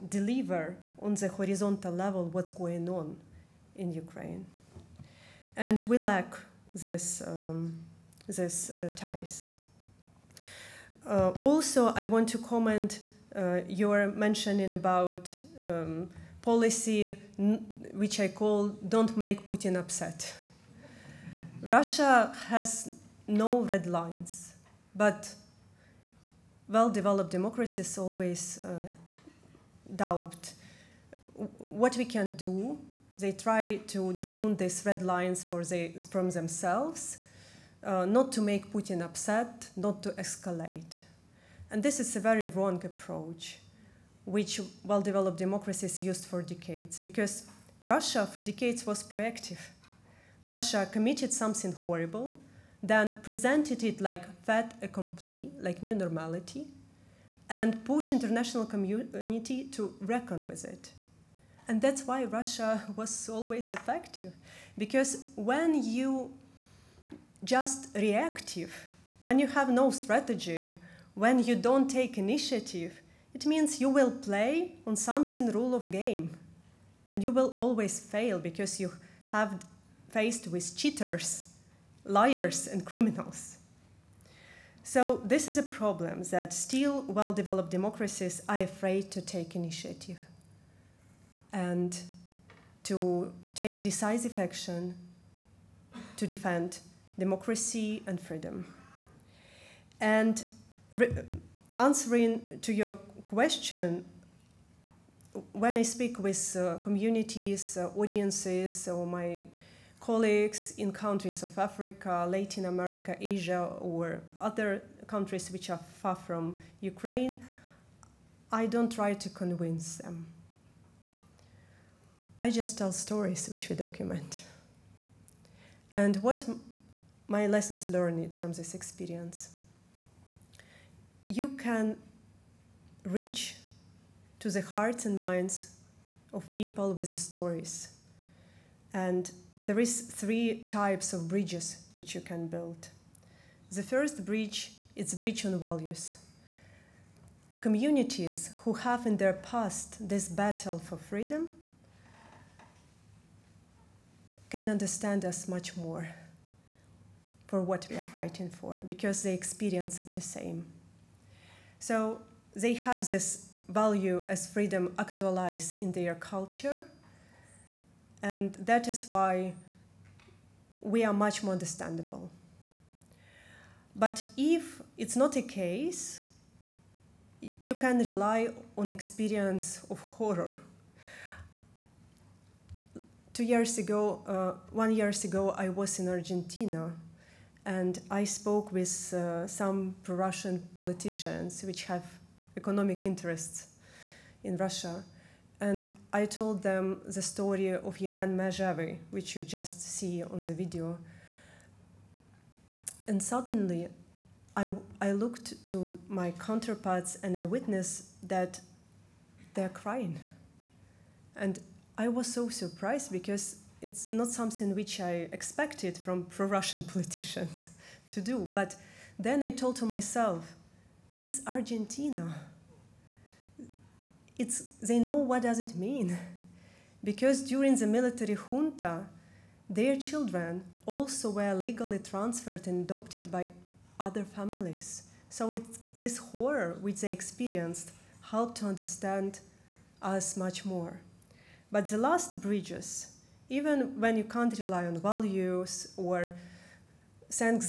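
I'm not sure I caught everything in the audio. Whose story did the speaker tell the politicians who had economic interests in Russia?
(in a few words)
Yevhen Mezhevyi.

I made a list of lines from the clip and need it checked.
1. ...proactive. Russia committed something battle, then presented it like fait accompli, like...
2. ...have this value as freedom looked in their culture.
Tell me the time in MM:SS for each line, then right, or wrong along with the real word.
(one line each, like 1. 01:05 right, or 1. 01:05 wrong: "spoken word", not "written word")
1. 00:49 wrong: "horrible", not "battle"
2. 02:42 wrong: "actualized", not "looked".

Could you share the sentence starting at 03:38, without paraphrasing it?
But then I told to myself, it's Argentina.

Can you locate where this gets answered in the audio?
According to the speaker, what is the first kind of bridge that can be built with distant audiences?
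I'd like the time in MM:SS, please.
02:25.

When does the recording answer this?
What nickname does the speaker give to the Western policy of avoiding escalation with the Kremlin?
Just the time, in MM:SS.
00:18.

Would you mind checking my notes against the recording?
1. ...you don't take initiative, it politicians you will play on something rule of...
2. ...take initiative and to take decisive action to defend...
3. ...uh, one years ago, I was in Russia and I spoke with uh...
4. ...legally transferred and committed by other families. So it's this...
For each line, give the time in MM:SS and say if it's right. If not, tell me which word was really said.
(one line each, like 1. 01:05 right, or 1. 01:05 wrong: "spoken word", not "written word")
1. 01:11 wrong: "means", not "politicians"
2. 01:29 right
3. 03:04 wrong: "Argentina", not "Russia"
4. 03:51 wrong: "adopted", not "committed".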